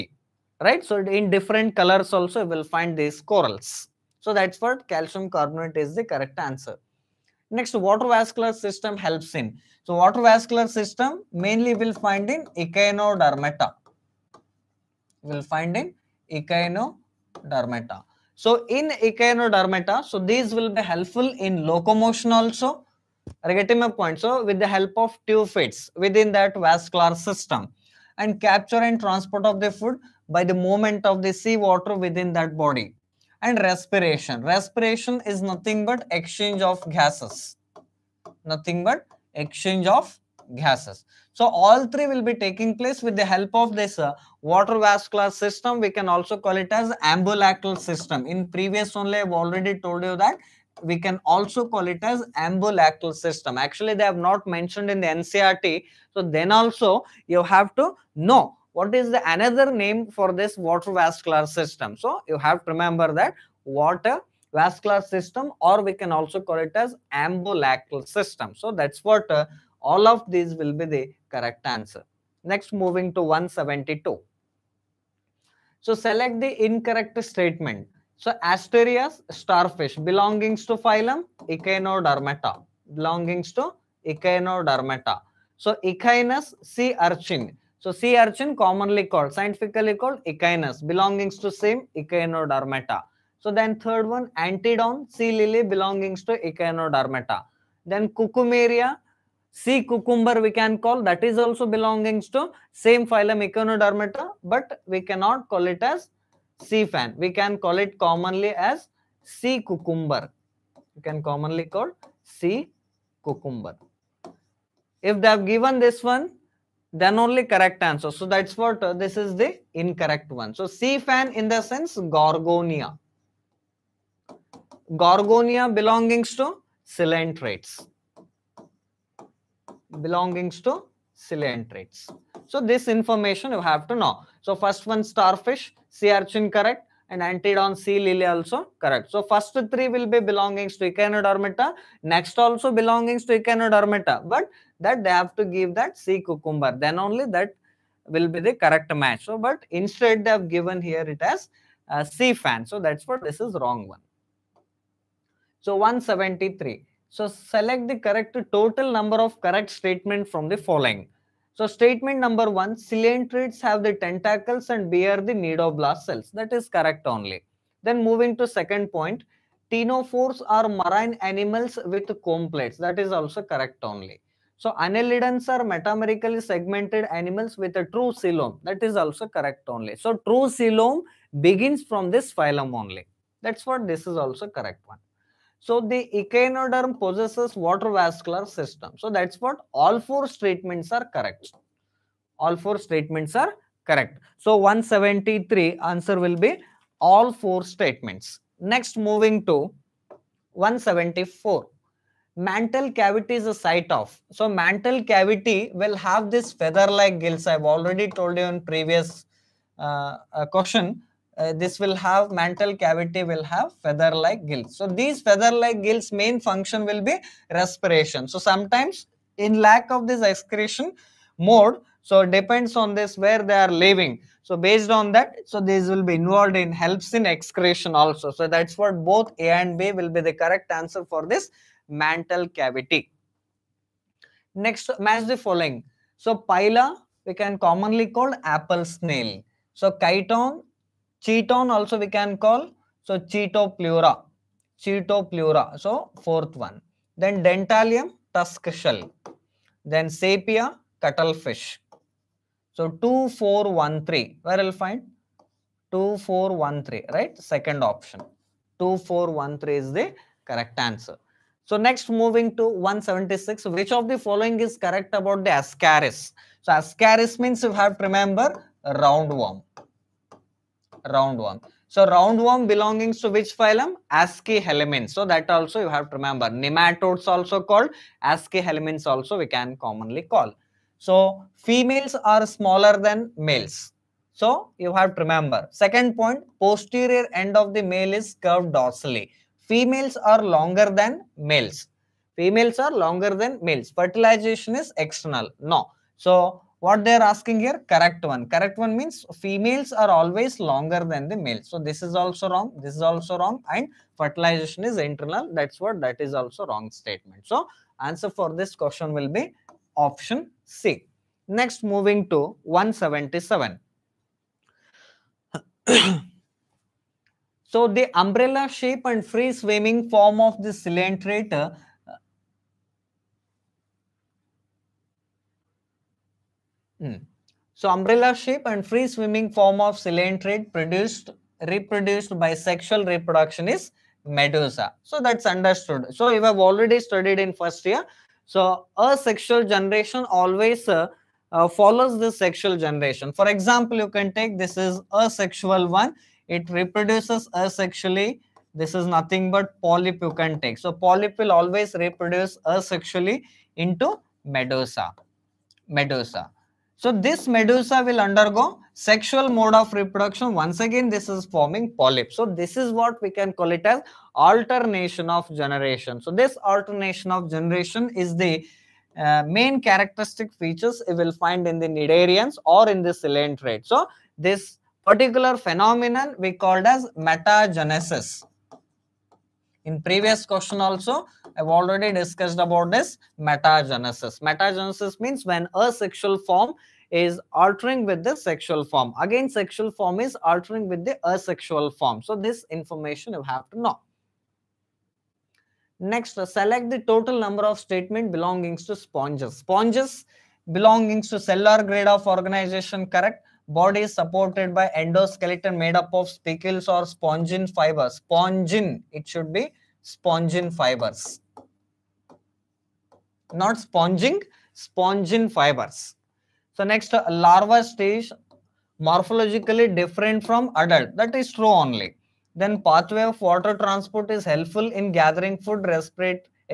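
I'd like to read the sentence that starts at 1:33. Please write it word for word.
So then third one, Antedon, sea lily belongs to Echinodermata.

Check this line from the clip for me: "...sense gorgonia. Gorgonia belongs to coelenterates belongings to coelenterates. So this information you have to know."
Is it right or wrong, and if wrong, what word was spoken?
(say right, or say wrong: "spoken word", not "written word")
right.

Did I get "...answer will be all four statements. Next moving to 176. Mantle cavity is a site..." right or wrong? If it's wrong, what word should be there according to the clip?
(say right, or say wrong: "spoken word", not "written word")
wrong: "174", not "176".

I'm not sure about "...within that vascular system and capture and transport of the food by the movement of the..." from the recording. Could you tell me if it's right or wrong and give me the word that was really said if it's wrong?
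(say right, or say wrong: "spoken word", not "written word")
right.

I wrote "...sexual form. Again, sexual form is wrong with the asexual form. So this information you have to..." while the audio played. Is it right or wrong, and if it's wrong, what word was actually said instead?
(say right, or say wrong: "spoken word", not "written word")
wrong: "altering", not "wrong".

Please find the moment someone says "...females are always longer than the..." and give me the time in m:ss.
4:59.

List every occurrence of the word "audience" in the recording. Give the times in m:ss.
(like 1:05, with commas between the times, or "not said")
not said.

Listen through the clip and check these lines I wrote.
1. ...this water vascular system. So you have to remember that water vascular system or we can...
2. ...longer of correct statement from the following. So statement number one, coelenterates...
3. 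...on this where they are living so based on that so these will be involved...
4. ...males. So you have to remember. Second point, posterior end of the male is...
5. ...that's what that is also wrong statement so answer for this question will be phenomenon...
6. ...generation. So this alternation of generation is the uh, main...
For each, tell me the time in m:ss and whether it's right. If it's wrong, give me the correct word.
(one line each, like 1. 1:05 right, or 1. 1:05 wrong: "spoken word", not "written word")
1. 1:00 right
2. 2:38 wrong: "number", not "longer"
3. 3:42 right
4. 4:43 right
5. 5:05 wrong: "option", not "phenomenon"
6. 6:05 right.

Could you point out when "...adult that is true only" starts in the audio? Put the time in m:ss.
7:00.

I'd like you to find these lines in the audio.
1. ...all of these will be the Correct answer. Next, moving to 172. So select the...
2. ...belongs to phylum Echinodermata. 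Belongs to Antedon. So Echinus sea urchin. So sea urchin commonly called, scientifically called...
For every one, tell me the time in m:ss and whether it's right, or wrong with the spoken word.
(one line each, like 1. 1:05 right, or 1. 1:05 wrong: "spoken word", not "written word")
1. 1:09 right
2. 1:19 wrong: "Echinodermata", not "Antedon".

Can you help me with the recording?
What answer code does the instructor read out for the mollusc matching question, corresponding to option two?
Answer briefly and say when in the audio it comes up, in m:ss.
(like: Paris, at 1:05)
2413, at 4:18.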